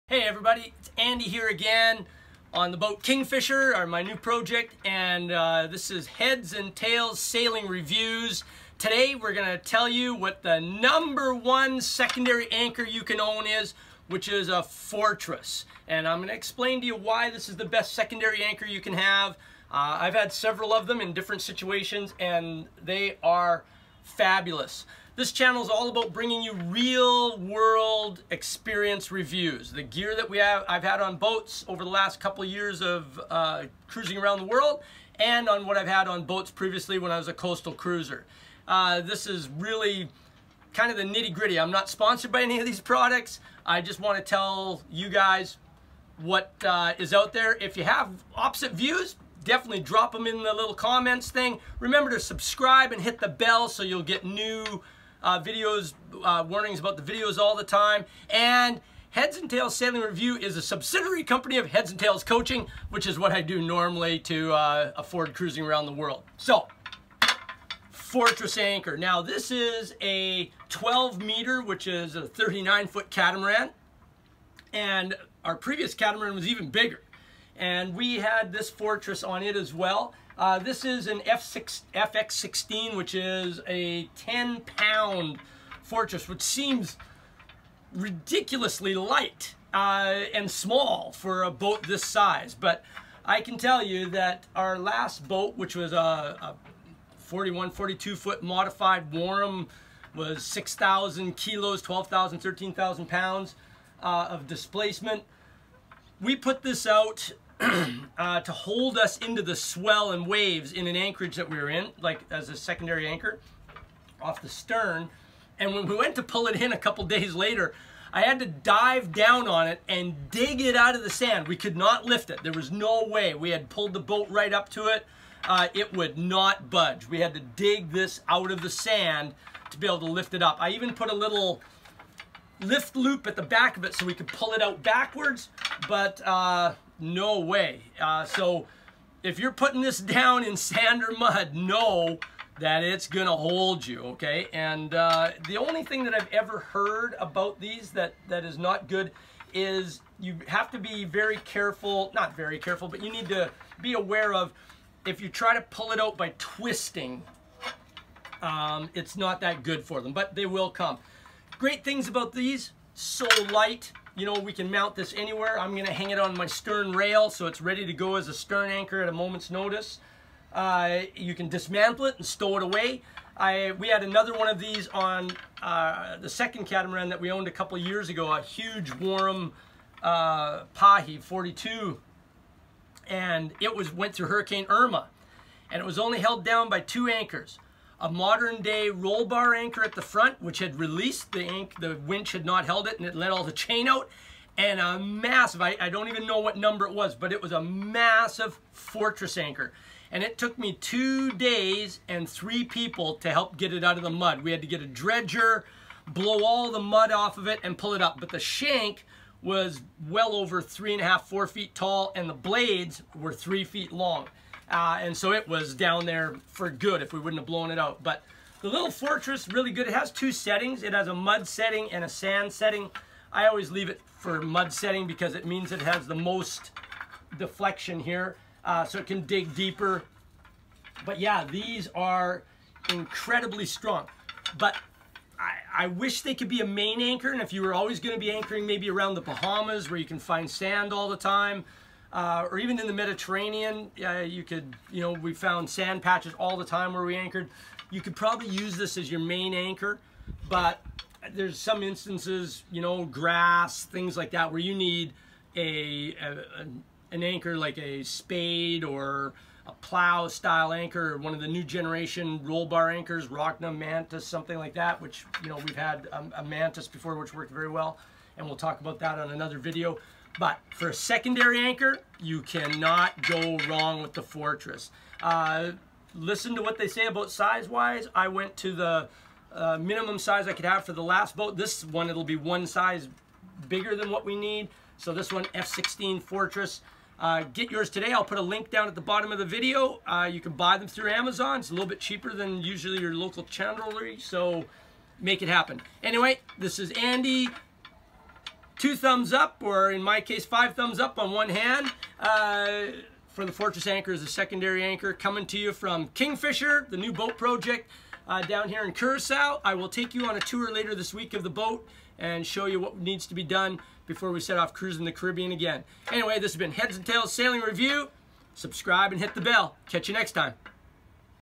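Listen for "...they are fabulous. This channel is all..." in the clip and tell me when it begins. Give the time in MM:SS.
00:22.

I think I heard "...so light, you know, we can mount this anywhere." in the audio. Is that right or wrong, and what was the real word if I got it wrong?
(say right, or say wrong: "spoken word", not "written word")
right.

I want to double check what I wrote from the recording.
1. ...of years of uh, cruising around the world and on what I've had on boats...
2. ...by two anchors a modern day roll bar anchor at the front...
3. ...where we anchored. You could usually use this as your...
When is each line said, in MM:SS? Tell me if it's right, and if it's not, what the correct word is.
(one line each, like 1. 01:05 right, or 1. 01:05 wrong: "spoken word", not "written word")
1. 00:32 right
2. 03:06 right
3. 04:06 wrong: "probably", not "usually".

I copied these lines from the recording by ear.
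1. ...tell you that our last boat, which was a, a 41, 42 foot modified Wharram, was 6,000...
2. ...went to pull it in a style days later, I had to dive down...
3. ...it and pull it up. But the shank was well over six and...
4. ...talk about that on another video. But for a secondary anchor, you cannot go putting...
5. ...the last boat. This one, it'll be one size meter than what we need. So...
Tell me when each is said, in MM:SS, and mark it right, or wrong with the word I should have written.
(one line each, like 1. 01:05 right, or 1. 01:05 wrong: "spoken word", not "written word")
1. 01:33 right
2. 01:55 wrong: "couple", not "style"
3. 03:27 wrong: "three", not "six"
4. 04:28 wrong: "wrong", not "putting"
5. 04:40 wrong: "bigger", not "meter".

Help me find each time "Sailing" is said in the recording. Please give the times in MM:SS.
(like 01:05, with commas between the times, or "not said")
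00:07, 00:59, 05:17.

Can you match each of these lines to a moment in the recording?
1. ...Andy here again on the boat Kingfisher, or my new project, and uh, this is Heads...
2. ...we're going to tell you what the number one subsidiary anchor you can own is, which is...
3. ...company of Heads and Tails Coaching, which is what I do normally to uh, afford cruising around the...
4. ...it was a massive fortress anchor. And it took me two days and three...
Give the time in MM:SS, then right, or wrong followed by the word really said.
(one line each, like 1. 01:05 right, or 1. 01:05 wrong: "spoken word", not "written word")
1. 00:00 right
2. 00:09 wrong: "secondary", not "subsidiary"
3. 01:01 right
4. 03:17 right.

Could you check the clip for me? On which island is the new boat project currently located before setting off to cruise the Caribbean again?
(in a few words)
Curacao.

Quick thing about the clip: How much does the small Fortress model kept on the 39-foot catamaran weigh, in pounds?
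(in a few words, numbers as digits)
10.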